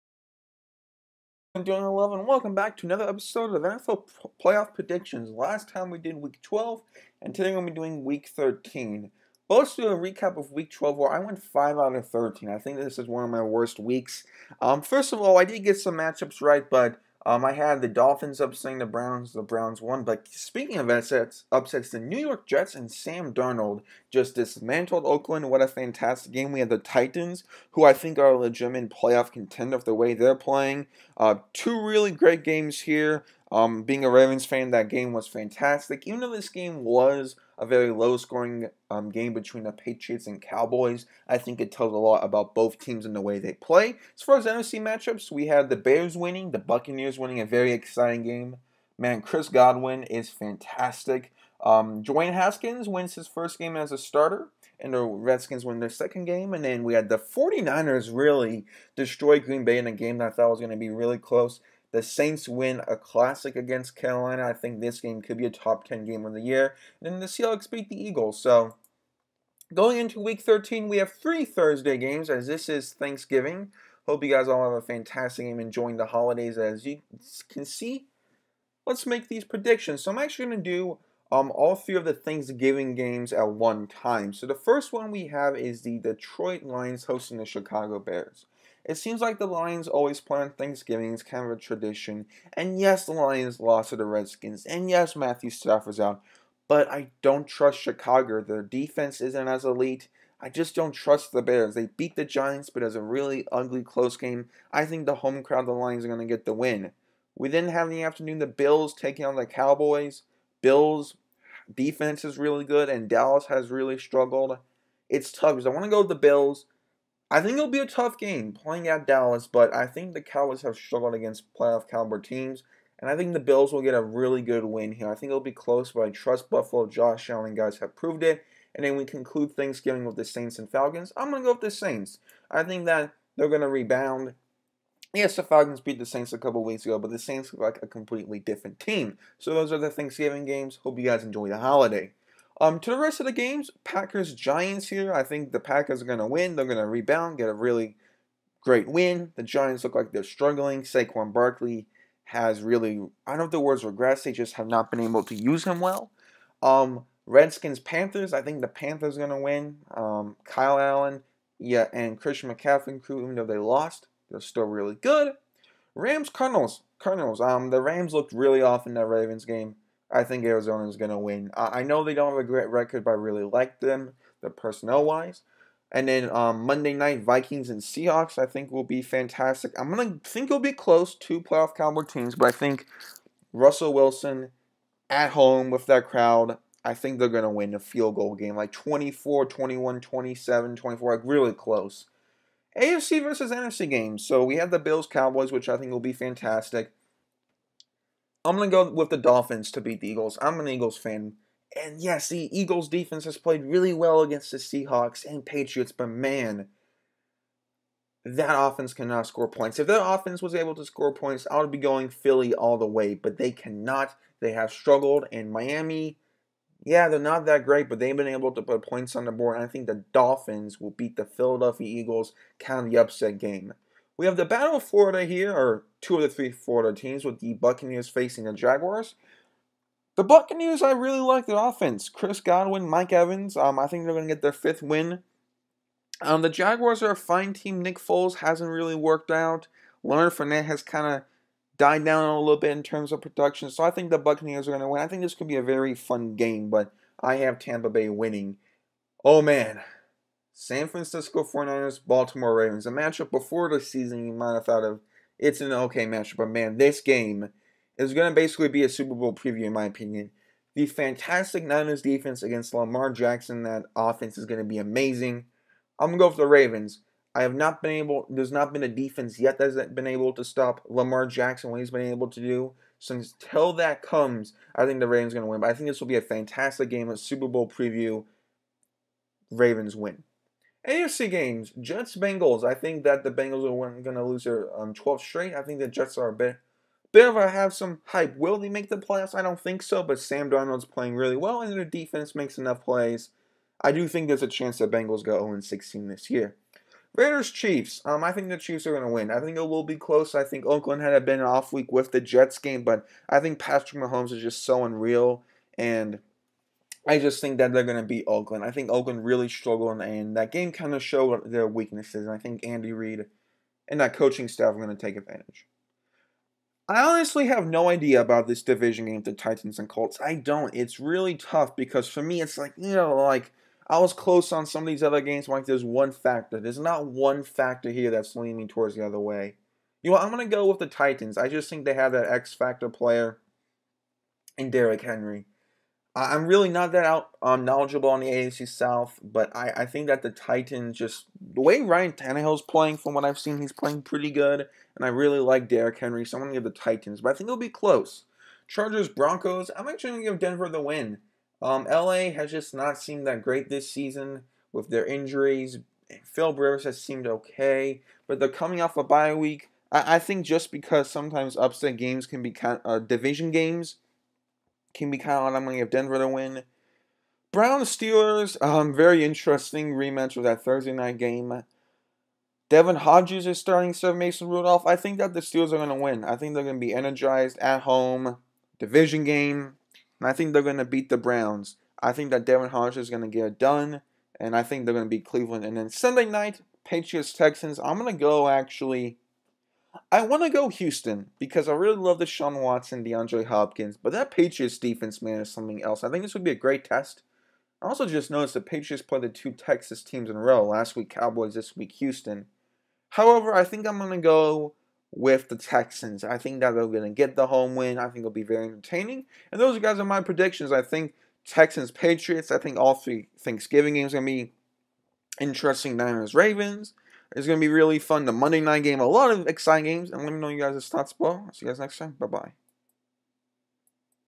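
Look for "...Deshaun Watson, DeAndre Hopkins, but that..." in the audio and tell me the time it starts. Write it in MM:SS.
06:32.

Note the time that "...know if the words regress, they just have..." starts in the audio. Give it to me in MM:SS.
02:33.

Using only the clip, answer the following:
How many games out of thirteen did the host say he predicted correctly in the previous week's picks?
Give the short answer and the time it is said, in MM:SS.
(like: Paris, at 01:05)
5, at 00:11.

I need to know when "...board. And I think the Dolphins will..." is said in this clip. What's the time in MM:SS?
03:39.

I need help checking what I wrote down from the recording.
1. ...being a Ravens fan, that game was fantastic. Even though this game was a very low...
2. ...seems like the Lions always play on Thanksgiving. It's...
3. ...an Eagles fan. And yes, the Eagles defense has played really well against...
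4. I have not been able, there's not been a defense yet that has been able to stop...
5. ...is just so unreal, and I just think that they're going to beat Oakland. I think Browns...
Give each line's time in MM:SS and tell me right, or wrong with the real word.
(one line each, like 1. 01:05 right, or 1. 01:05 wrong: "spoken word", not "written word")
1. 00:33 right
2. 01:28 right
3. 03:20 right
4. 04:27 right
5. 05:04 wrong: "Oakland", not "Browns".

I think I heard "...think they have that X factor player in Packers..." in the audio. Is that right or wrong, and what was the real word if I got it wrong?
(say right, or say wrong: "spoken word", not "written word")
wrong: "Derrick", not "Packers".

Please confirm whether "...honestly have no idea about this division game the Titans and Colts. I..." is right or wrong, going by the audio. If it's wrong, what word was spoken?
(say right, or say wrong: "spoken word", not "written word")
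right.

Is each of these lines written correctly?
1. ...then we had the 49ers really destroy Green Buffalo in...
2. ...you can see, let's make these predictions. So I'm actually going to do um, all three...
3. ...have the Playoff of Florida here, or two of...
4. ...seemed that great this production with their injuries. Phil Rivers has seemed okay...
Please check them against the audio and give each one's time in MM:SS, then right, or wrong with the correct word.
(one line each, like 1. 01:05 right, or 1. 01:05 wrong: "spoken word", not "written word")
1. 00:56 wrong: "Bay", not "Buffalo"
2. 01:16 right
3. 03:44 wrong: "Battle", not "Playoff"
4. 05:53 wrong: "season", not "production".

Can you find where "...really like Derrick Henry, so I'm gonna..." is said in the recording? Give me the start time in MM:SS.
05:45.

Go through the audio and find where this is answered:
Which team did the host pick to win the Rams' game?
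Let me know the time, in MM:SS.
02:50.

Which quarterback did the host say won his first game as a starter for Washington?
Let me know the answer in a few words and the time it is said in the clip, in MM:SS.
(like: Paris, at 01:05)
Dwayne Haskins, at 00:52.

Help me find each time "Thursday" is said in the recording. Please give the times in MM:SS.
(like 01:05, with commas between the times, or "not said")
01:11, 06:10.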